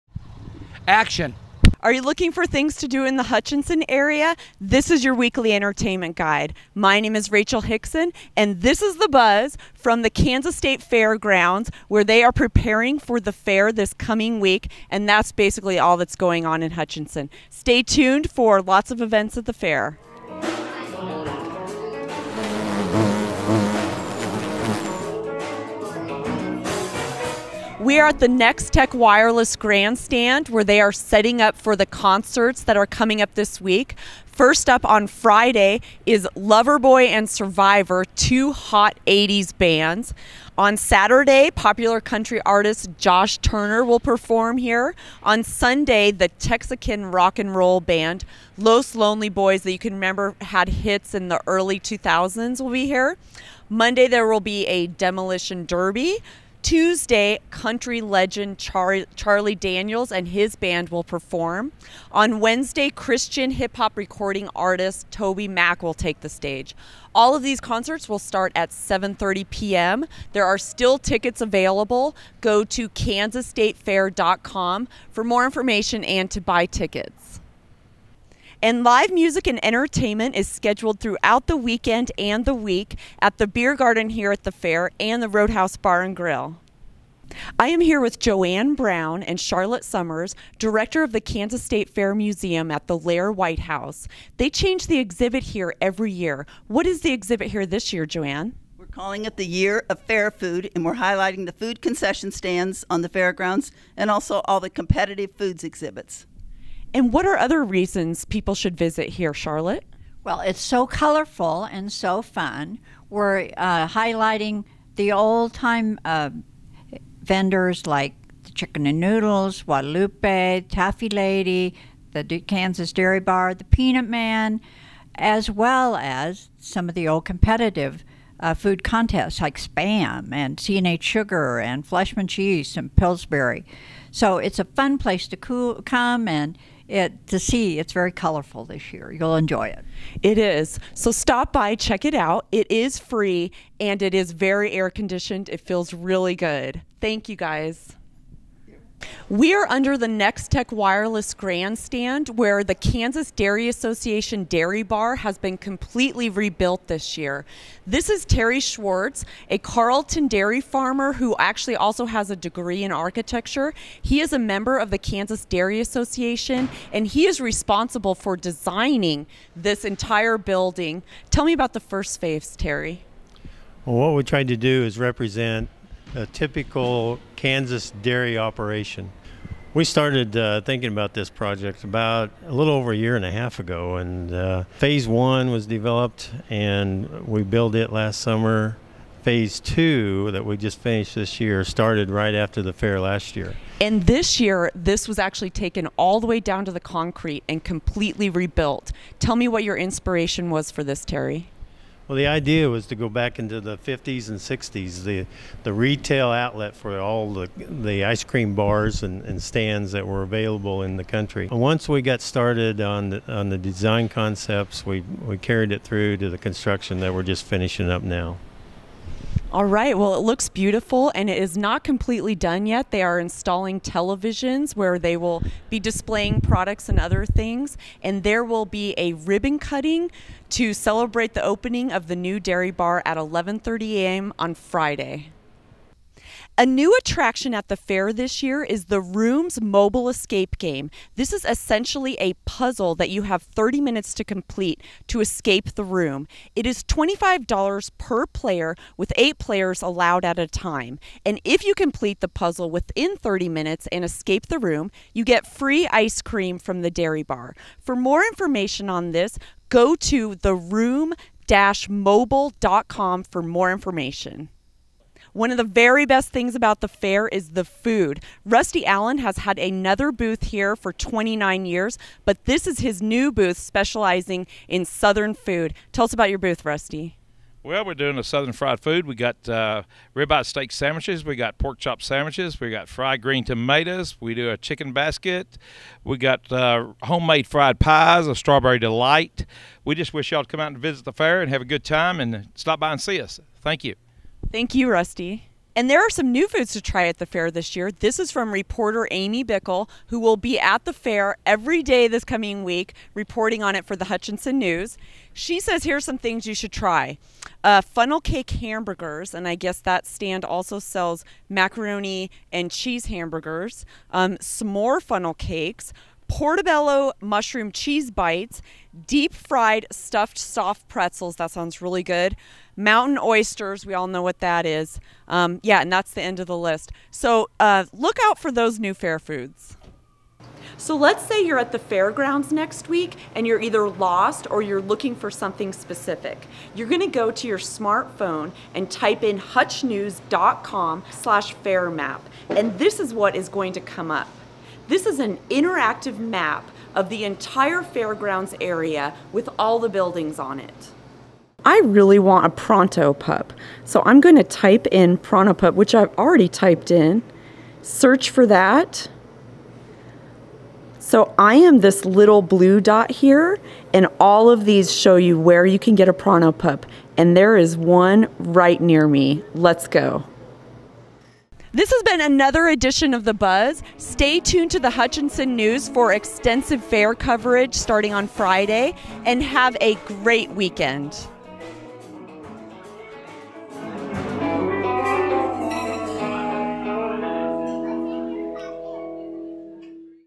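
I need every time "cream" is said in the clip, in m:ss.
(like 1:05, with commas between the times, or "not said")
3:28, 4:16.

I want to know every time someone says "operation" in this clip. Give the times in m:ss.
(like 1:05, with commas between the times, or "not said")
2:58.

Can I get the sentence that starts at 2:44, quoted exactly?
He is a member of the Kansas Dairy Association and he is responsible for designing this entire building.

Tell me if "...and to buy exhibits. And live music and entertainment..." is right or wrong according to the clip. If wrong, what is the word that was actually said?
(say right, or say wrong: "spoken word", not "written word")
wrong: "tickets", not "exhibits".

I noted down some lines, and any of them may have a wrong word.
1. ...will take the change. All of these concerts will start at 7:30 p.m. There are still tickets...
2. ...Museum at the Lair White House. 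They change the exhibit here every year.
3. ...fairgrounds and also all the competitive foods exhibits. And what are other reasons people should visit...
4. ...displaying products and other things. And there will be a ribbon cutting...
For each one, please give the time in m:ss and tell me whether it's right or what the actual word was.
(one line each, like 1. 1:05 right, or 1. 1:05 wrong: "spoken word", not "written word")
1. 1:05 wrong: "stage", not "change"
2. 1:32 right
3. 1:43 right
4. 3:45 right.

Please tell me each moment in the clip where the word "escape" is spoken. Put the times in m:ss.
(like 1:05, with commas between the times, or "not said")
4:00, 4:05, 4:14.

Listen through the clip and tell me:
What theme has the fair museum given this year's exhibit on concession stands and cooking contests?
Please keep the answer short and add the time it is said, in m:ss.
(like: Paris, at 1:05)
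Year of Fair Food, at 1:39.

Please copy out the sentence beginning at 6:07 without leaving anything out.
And there is one right near me.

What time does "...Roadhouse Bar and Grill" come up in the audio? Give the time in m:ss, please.
1:25.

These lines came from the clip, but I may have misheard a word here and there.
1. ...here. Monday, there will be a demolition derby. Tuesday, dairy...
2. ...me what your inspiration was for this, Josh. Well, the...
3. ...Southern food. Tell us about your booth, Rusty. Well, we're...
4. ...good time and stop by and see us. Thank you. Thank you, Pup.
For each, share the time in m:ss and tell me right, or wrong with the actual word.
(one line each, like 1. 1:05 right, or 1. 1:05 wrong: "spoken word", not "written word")
1. 0:52 wrong: "country", not "dairy"
2. 3:19 wrong: "Terry", not "Josh"
3. 4:34 right
4. 4:51 wrong: "Rusty", not "Pup".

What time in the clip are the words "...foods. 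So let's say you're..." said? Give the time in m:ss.
5:29.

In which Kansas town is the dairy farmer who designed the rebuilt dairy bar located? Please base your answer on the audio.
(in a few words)
Carlton.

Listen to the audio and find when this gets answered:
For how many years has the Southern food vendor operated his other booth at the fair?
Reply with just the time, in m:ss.
4:30.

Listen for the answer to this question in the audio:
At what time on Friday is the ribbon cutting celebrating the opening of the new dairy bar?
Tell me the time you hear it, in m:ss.
3:53.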